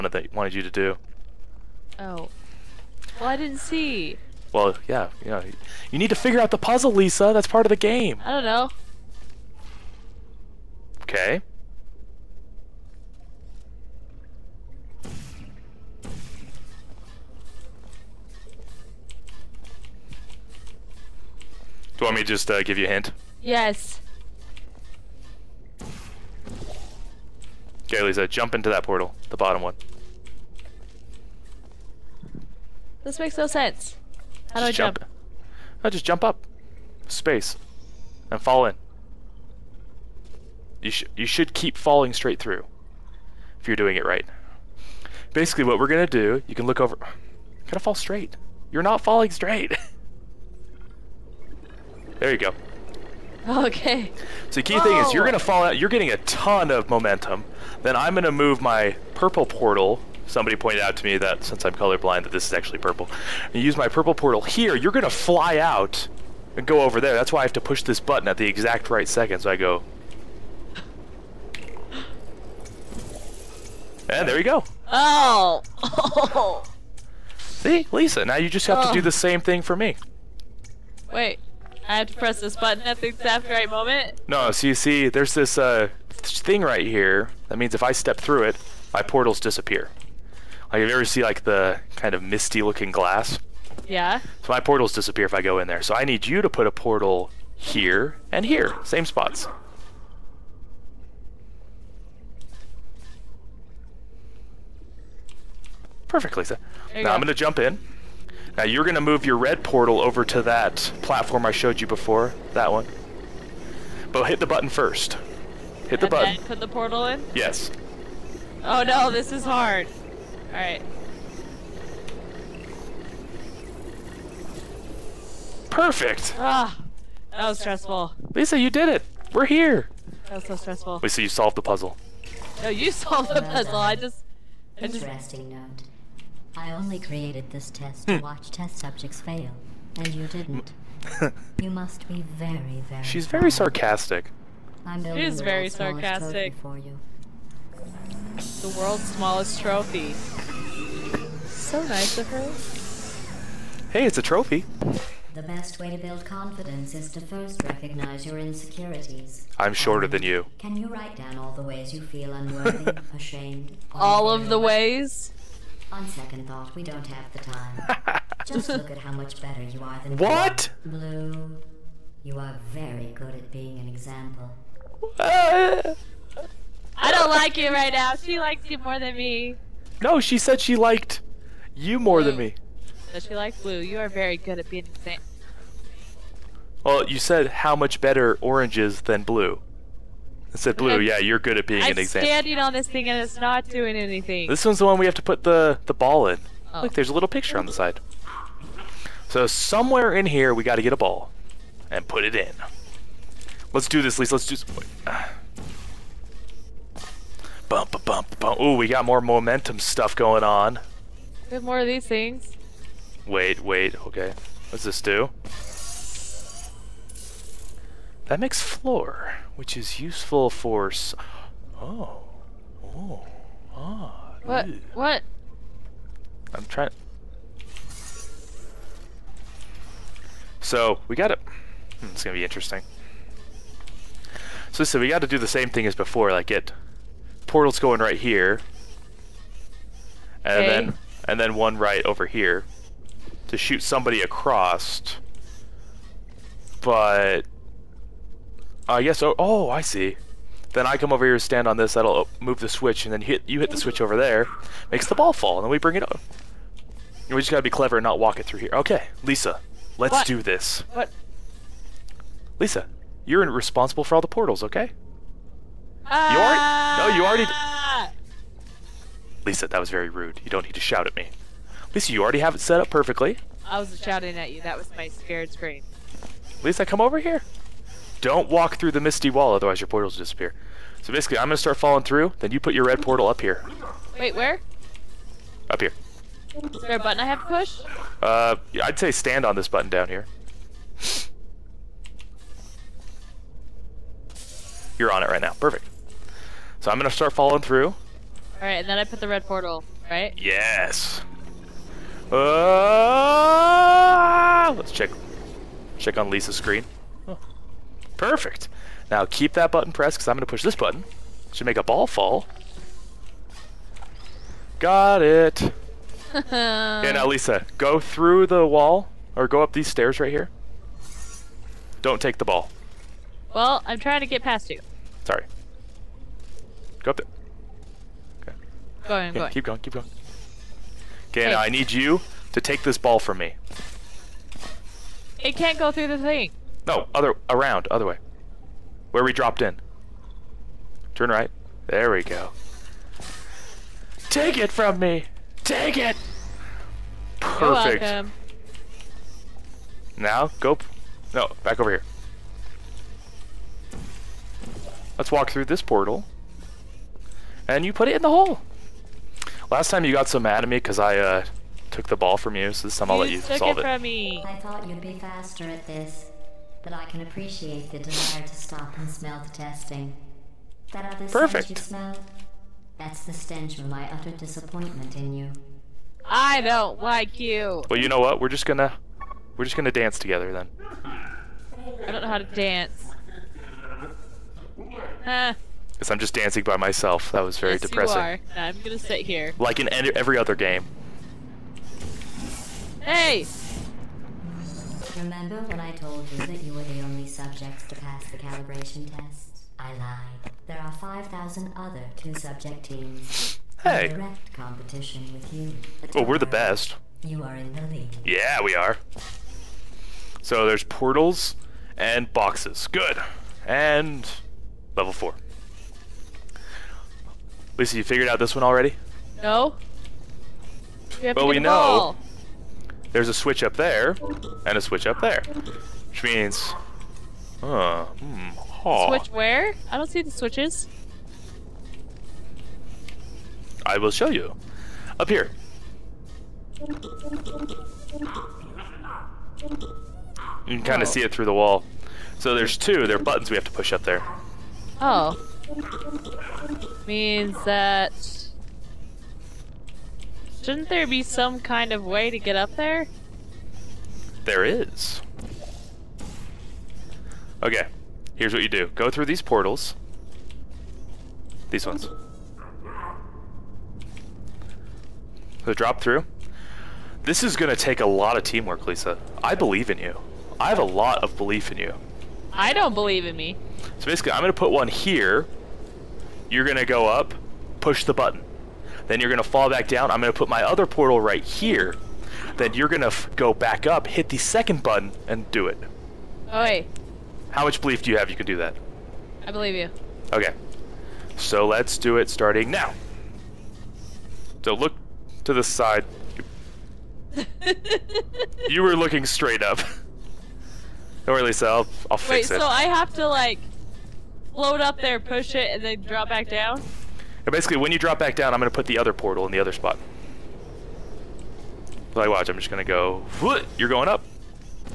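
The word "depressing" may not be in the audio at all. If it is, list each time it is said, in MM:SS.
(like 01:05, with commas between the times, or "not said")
06:27.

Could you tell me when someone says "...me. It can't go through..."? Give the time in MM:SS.
05:33.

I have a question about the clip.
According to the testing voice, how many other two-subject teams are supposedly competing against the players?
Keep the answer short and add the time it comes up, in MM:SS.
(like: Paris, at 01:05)
5000, at 06:40.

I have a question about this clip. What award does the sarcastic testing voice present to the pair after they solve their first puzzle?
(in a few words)
The world's smallest trophy.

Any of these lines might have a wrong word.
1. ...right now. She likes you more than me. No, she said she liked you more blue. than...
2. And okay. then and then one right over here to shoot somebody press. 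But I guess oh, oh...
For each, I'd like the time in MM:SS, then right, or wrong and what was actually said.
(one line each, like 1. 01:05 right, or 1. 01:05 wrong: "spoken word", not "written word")
1. 02:57 right
2. 04:00 wrong: "across", not "press".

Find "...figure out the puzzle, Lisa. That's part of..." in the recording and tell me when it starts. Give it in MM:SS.
00:06.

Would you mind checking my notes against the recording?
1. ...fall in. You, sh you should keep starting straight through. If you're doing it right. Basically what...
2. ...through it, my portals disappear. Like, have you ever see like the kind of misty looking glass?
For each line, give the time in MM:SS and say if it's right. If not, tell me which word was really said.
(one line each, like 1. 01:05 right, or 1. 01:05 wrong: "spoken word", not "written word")
1. 00:38 wrong: "falling", not "starting"
2. 01:28 right.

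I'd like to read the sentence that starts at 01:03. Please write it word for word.
You use my purple portal here, you're gonna fly out and go over there.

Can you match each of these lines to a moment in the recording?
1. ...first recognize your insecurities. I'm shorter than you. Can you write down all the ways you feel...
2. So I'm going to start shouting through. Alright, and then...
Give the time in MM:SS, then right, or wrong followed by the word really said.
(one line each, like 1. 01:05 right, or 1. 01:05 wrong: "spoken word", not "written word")
1. 02:37 right
2. 04:56 wrong: "following", not "shouting".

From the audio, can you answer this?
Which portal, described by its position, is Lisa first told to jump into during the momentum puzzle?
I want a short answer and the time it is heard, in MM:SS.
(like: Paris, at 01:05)
The bottom one, at 00:29.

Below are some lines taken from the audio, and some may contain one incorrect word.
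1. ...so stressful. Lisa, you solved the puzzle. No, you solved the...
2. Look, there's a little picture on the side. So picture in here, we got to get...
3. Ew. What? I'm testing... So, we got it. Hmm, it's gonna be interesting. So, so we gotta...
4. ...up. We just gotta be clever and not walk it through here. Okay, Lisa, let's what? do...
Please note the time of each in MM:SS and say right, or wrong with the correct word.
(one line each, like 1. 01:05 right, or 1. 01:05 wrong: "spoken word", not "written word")
1. 02:10 right
2. 03:16 wrong: "somewhere", not "picture"
3. 03:44 wrong: "trying", not "testing"
4. 04:16 right.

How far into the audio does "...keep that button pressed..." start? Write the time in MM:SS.
05:09.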